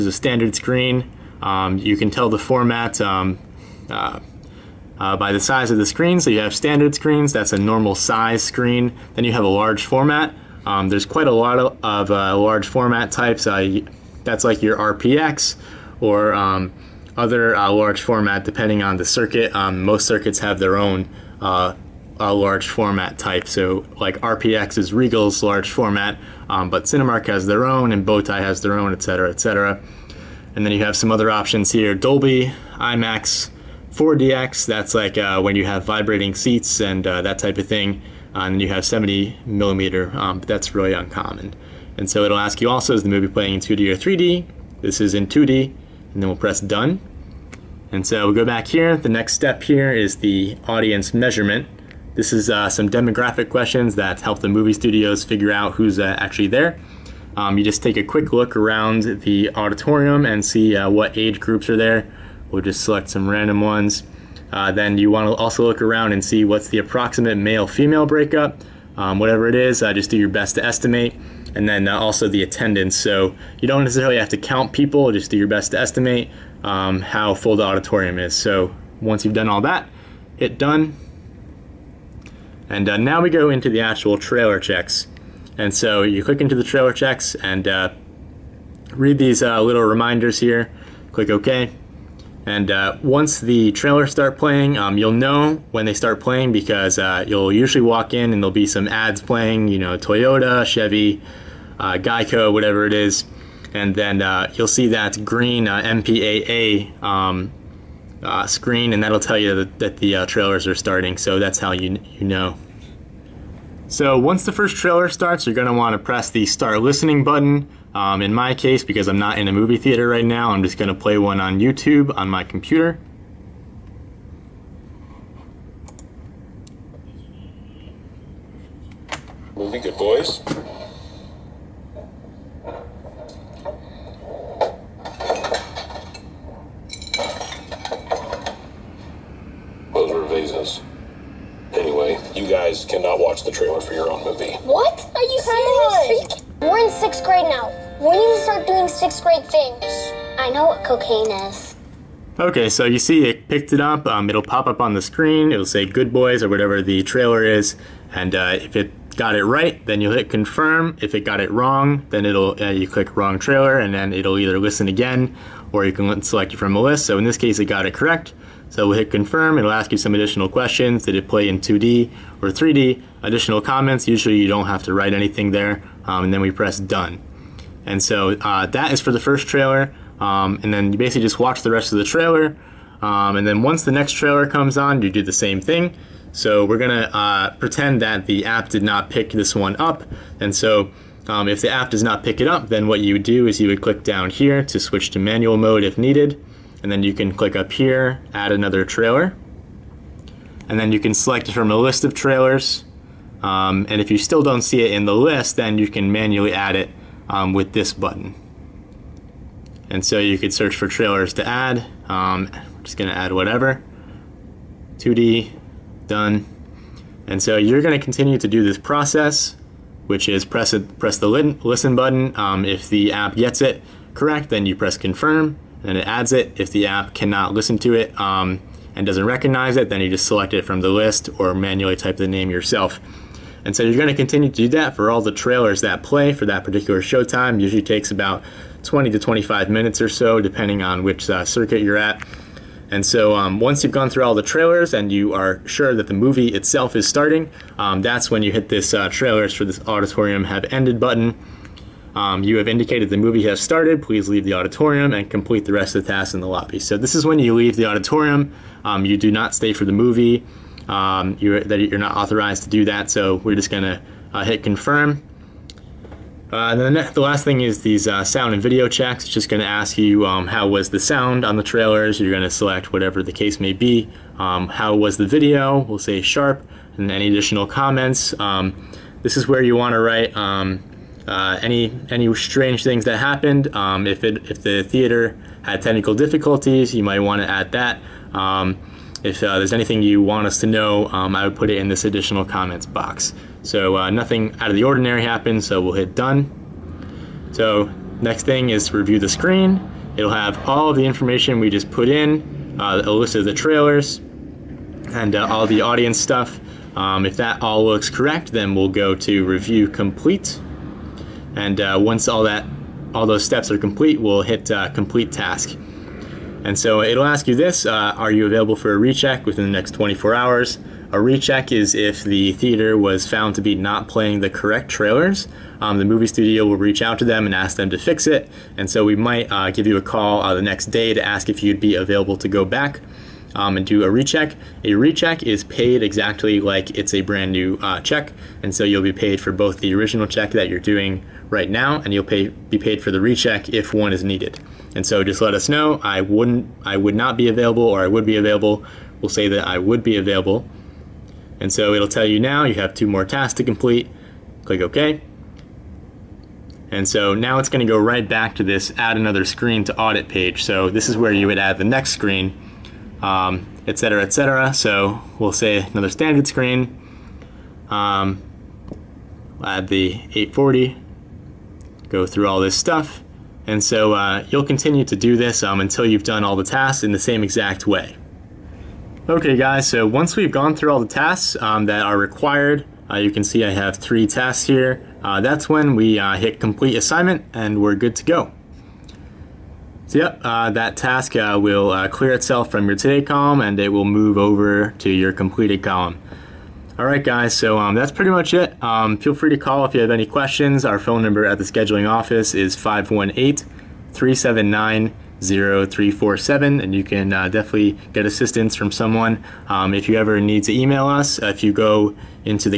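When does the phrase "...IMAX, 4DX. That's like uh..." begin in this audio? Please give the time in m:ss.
0:32.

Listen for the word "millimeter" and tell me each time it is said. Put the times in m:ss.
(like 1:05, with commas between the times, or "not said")
0:39.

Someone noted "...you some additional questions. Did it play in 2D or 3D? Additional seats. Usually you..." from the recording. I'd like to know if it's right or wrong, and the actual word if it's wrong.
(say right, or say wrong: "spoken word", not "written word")
wrong: "comments", not "seats".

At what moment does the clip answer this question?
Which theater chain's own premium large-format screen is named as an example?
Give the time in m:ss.
0:24.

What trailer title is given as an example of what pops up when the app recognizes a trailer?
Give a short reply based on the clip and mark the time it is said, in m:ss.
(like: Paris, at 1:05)
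Good Boys, at 2:35.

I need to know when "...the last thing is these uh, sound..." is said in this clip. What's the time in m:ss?
4:27.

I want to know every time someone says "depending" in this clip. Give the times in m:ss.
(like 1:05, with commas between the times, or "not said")
0:18, 4:00.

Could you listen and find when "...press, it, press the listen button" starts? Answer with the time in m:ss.
3:40.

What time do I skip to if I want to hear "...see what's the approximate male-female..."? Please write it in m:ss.
1:06.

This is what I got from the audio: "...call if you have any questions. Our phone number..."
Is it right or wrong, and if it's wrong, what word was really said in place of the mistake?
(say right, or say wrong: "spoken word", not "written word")
right.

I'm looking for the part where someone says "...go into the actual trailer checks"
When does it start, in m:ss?
1:23.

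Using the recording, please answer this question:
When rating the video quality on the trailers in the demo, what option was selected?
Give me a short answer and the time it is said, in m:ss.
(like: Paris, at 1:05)
Sharp, at 4:36.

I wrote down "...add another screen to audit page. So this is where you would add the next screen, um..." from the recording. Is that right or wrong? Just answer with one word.
right.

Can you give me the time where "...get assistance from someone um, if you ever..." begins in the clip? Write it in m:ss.
6:48.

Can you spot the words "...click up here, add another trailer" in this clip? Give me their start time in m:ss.
3:17.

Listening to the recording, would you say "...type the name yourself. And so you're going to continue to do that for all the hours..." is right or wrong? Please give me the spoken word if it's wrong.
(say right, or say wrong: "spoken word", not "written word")
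wrong: "trailers", not "hours".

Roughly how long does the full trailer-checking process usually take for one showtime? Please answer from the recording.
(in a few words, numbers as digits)
20 to 25 minutes.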